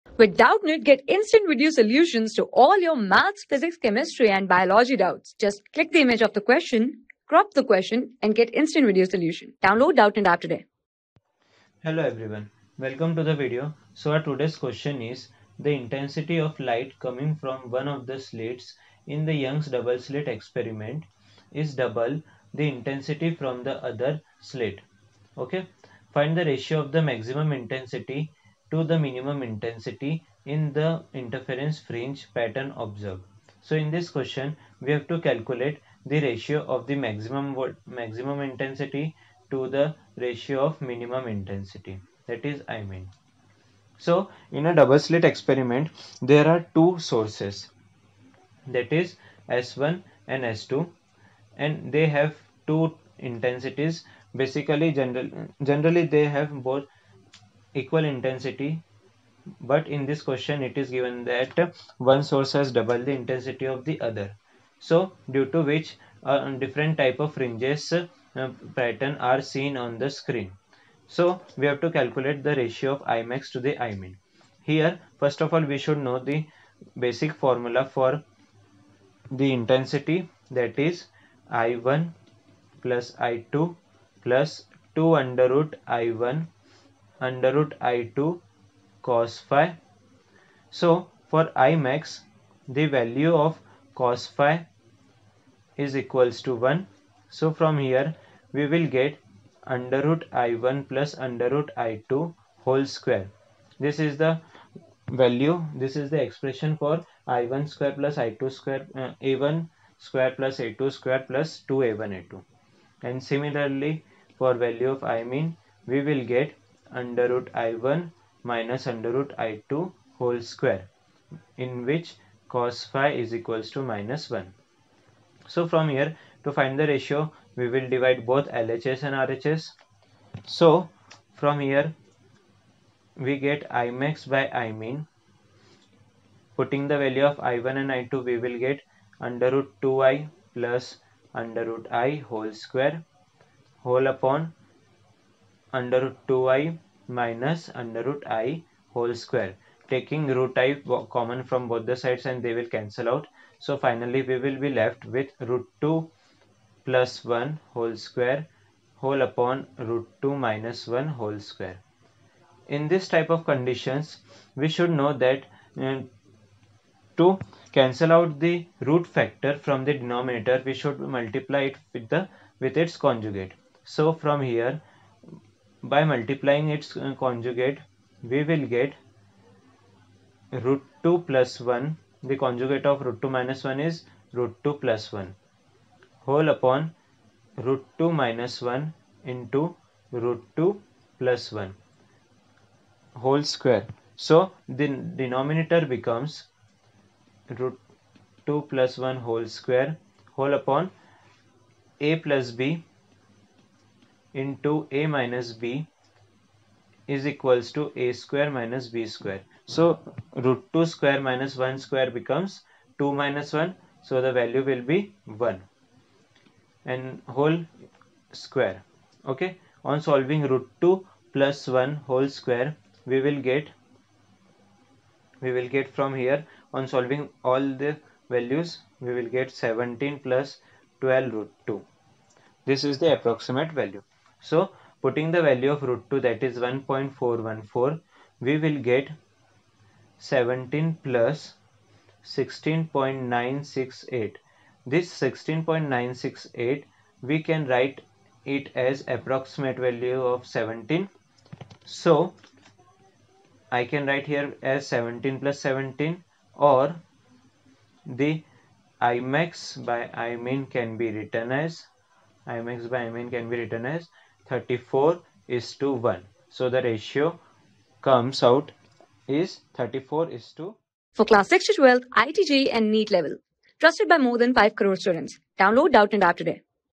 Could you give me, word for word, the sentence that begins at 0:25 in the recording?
Okay, find the ratio of the maximum intensity to the minimum intensity in the interference fringe pattern observed.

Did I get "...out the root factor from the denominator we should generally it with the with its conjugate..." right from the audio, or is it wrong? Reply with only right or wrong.
wrong.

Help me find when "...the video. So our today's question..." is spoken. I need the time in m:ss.
0:13.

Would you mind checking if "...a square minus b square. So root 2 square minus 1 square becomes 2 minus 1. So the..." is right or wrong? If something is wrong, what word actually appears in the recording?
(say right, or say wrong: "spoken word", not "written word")
right.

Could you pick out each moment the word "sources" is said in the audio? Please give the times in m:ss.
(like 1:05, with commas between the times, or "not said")
0:46, 1:02.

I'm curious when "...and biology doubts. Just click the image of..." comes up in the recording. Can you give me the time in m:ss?
0:04.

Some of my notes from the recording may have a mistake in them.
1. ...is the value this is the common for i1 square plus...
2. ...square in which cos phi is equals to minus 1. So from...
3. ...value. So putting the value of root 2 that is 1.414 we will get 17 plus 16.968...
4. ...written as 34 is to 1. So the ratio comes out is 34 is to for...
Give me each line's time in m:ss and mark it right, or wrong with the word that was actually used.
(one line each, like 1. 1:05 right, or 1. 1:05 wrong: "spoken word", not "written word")
1. 1:43 wrong: "expression", not "common"
2. 2:00 right
3. 3:53 right
4. 4:23 right.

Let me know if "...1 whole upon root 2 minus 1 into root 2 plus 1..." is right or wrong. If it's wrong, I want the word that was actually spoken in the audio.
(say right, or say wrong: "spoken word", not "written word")
right.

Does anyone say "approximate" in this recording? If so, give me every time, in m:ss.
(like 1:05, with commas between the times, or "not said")
3:53, 4:09.